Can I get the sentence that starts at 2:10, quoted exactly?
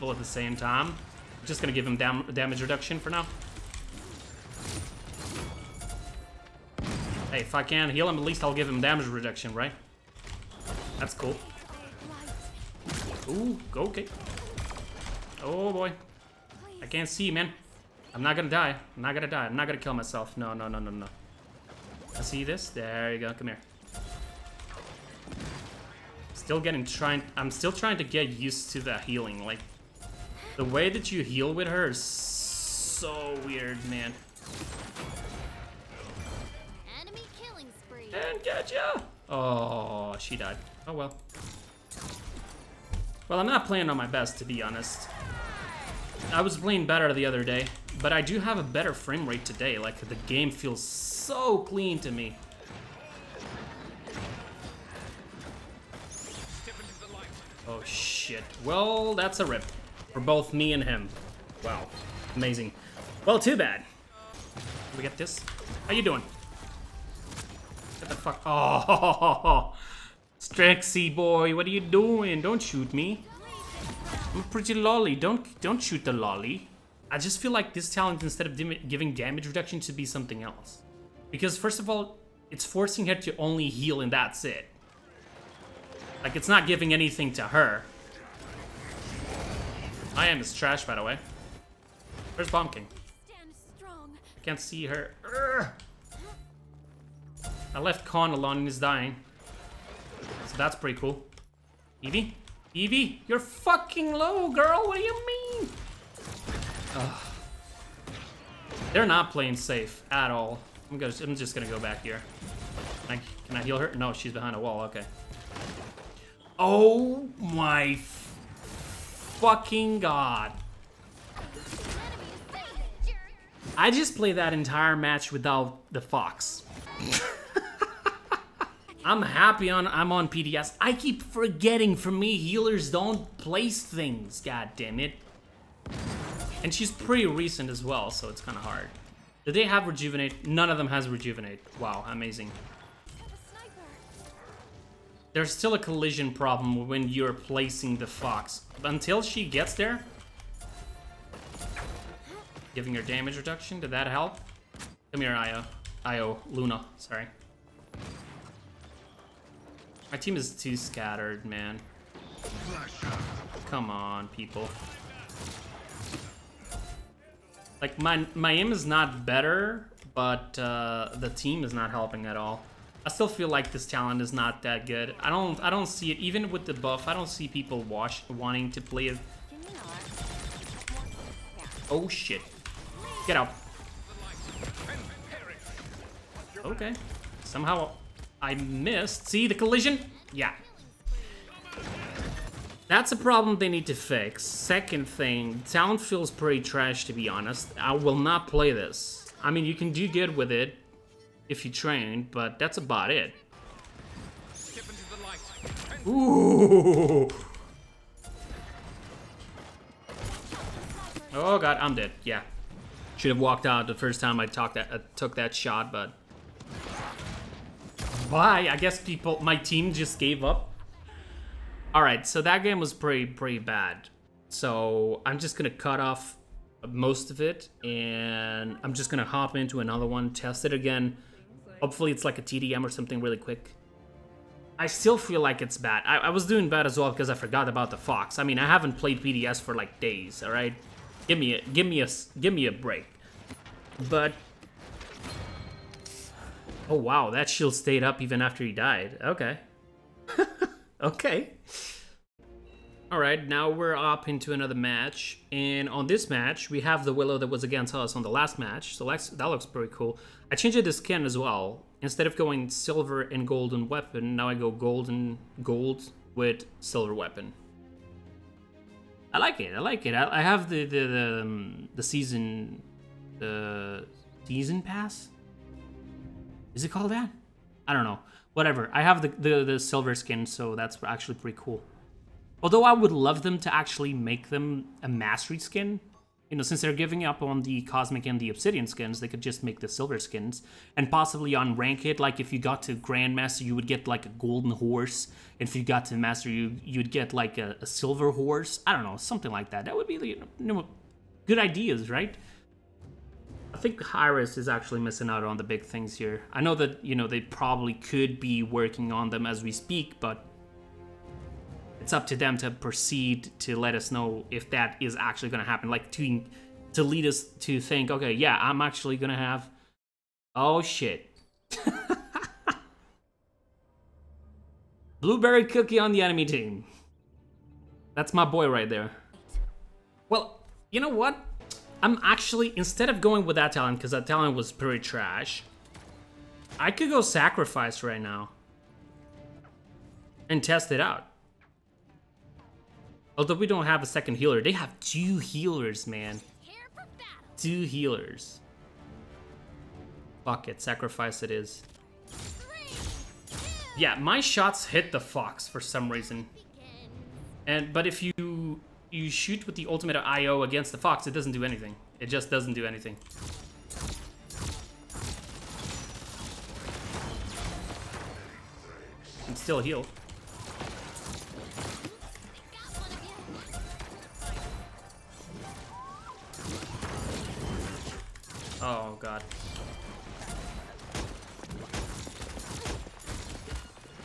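I keep forgetting for me healers don't place things, god damn it.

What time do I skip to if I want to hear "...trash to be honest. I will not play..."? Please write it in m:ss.
3:16.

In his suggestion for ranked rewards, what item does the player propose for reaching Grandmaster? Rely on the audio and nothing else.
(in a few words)
Golden Horse.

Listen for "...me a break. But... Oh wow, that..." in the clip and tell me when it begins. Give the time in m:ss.
4:02.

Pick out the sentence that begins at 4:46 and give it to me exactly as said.
You know, since they're giving up on the Cosmic and the Obsidian skins, they could just make the Silver skins.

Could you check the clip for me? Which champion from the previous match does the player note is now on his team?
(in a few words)
Willow.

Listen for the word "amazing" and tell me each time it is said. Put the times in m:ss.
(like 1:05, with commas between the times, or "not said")
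1:02, 2:22.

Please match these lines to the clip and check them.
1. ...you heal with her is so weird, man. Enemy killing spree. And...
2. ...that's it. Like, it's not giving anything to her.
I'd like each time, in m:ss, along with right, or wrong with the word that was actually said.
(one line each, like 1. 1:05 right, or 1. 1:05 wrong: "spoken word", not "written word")
1. 0:31 right
2. 1:24 right.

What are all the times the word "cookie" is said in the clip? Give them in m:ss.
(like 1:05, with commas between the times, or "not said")
5:25.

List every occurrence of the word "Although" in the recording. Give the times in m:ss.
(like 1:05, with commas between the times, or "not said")
4:42, 5:43.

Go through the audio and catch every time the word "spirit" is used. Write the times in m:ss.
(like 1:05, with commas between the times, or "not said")
not said.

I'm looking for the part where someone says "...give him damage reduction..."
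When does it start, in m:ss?
0:08.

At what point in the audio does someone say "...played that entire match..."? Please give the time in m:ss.
2:04.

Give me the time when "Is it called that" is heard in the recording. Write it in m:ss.
4:36.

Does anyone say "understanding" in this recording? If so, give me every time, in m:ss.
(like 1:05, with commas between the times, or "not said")
not said.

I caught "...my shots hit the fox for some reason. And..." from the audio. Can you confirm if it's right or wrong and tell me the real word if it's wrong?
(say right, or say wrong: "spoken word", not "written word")
right.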